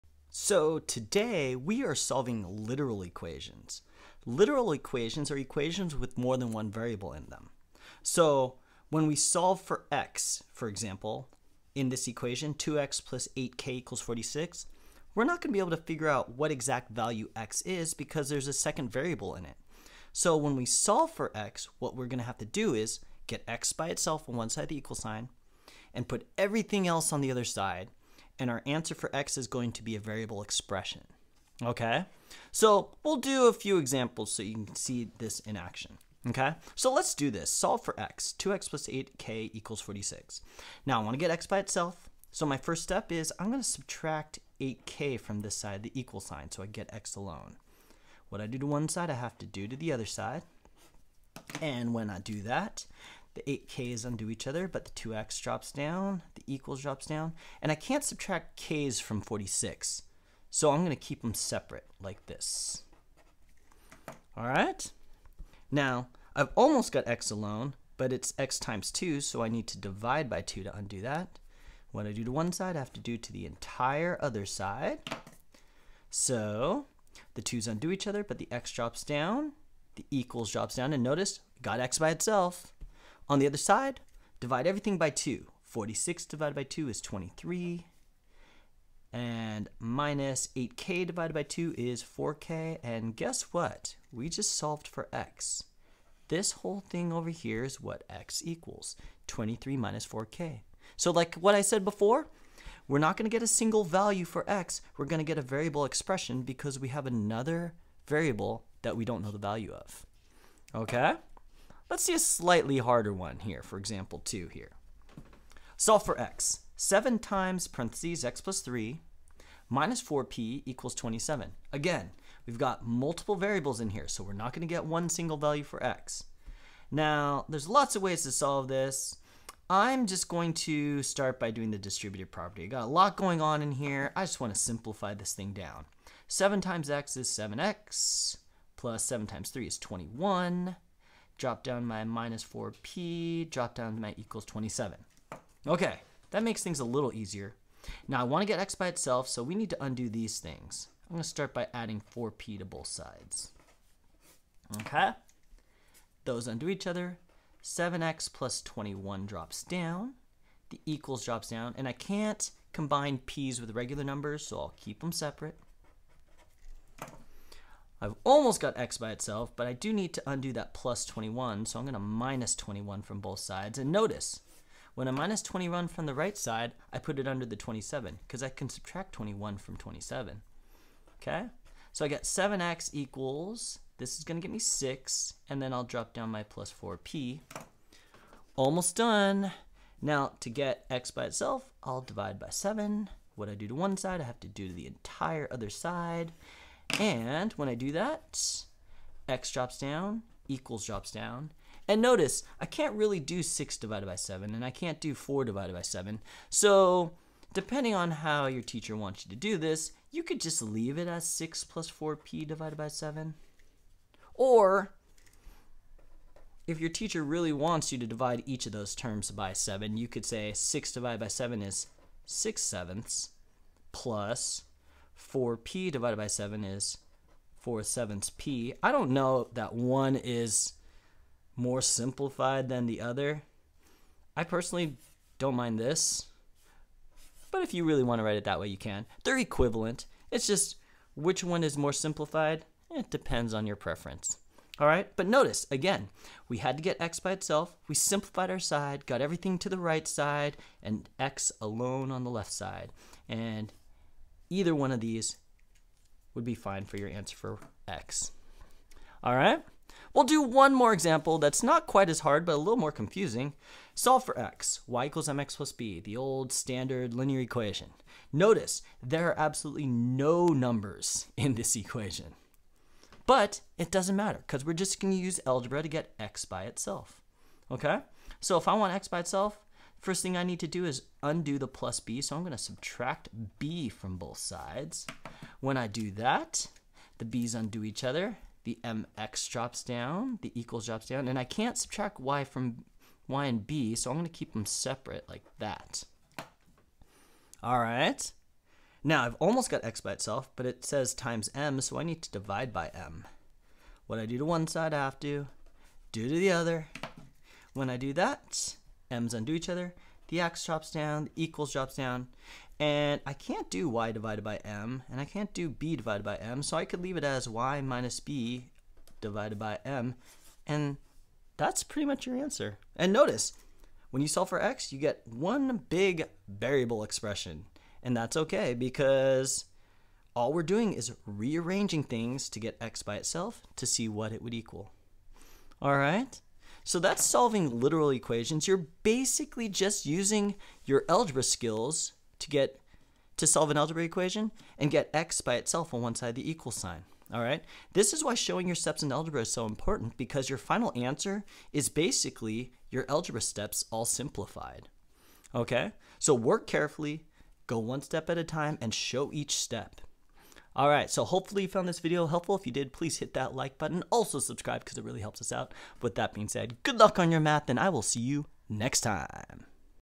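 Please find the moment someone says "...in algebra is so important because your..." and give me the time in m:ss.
5:49.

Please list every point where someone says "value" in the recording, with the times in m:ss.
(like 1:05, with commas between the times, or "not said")
0:16, 1:43, 1:49, 2:05.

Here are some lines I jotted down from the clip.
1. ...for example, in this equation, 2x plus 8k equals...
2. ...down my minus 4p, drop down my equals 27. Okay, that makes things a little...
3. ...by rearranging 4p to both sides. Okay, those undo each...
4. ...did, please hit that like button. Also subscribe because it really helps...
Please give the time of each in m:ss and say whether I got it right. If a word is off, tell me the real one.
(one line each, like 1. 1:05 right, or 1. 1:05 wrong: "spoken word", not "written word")
1. 0:10 right
2. 2:21 right
3. 2:31 wrong: "adding", not "rearranging"
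4. 6:02 right.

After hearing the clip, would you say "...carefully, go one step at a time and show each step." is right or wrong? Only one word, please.
right.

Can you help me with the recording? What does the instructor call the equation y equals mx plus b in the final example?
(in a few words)
standard linear equation.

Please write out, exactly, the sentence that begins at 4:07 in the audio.
We simplified our side, got everything to the right side, and x alone on the left side.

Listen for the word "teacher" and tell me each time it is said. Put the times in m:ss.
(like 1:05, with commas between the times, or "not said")
3:28, 3:36.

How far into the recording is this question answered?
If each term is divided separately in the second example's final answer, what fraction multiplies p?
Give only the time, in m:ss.
3:47.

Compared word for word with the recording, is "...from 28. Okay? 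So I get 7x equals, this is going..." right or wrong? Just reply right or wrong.
wrong.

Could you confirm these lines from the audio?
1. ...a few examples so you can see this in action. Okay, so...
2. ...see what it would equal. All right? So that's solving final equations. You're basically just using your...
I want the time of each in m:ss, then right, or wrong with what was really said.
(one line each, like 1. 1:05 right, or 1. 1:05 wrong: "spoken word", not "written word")
1. 0:33 right
2. 5:33 wrong: "literal", not "final".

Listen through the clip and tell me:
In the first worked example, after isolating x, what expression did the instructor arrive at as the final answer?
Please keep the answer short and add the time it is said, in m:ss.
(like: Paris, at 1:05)
23 minus 4k, at 1:39.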